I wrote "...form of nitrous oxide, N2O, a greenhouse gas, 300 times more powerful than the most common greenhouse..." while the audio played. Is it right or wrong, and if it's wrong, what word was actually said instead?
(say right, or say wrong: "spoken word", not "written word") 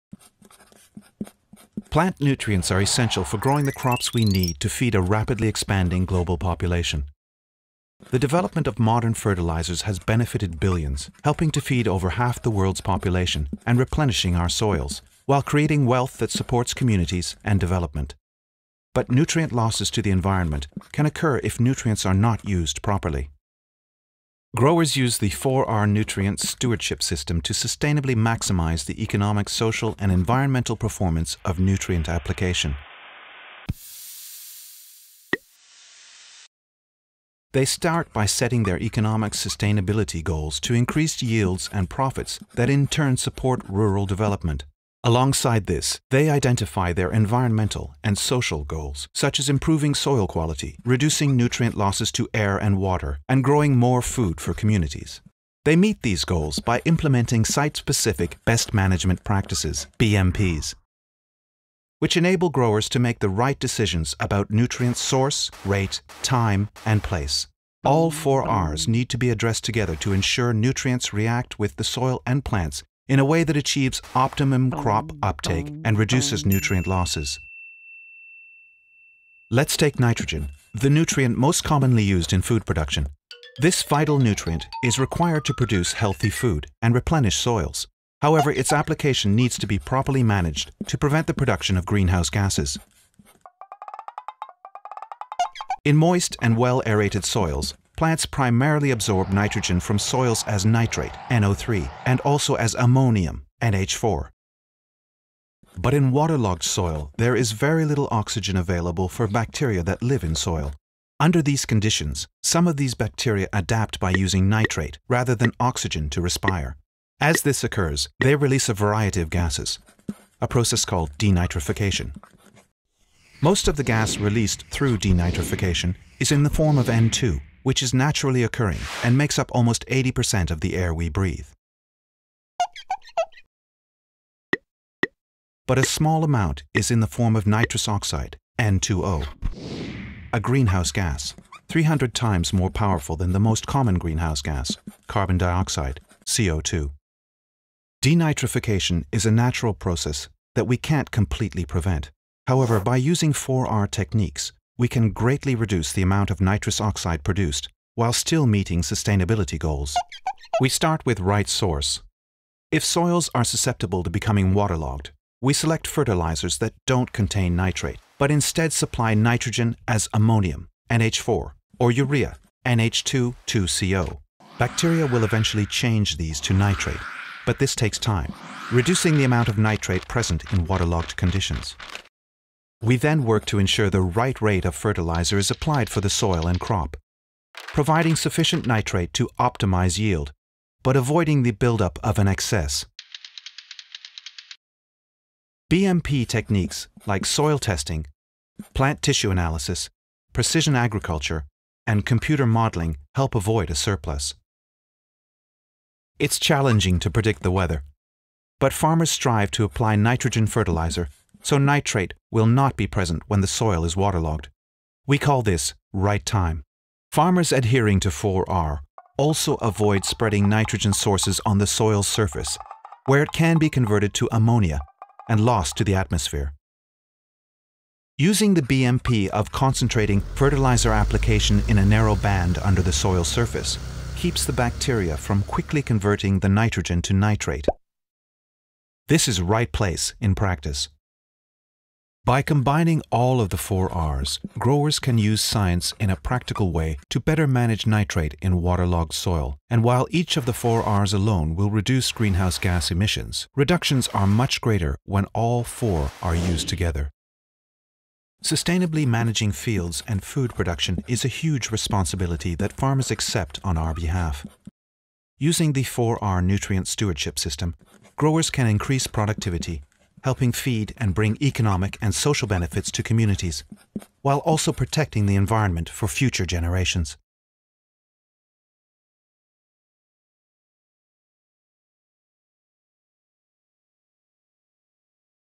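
right.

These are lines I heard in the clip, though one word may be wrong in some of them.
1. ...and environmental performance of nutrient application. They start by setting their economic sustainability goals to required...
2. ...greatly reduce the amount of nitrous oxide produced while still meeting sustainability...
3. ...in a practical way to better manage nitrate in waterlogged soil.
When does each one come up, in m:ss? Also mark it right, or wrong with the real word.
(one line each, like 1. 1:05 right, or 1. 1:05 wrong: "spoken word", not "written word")
1. 0:29 wrong: "increased", not "required"
2. 2:35 right
3. 4:05 right.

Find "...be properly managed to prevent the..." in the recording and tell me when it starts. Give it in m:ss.
1:29.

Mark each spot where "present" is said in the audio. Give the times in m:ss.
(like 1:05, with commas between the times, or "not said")
3:00, 3:32.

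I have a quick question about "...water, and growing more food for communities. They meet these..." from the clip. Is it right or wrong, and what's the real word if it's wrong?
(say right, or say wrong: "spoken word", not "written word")
right.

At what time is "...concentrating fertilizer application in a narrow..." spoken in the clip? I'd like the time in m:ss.
3:49.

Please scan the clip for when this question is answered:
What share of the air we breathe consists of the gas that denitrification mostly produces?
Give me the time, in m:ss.
2:09.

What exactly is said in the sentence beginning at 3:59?
This is right place in practice.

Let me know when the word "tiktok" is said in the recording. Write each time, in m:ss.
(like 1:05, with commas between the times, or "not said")
not said.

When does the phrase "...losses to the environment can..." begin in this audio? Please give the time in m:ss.
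0:19.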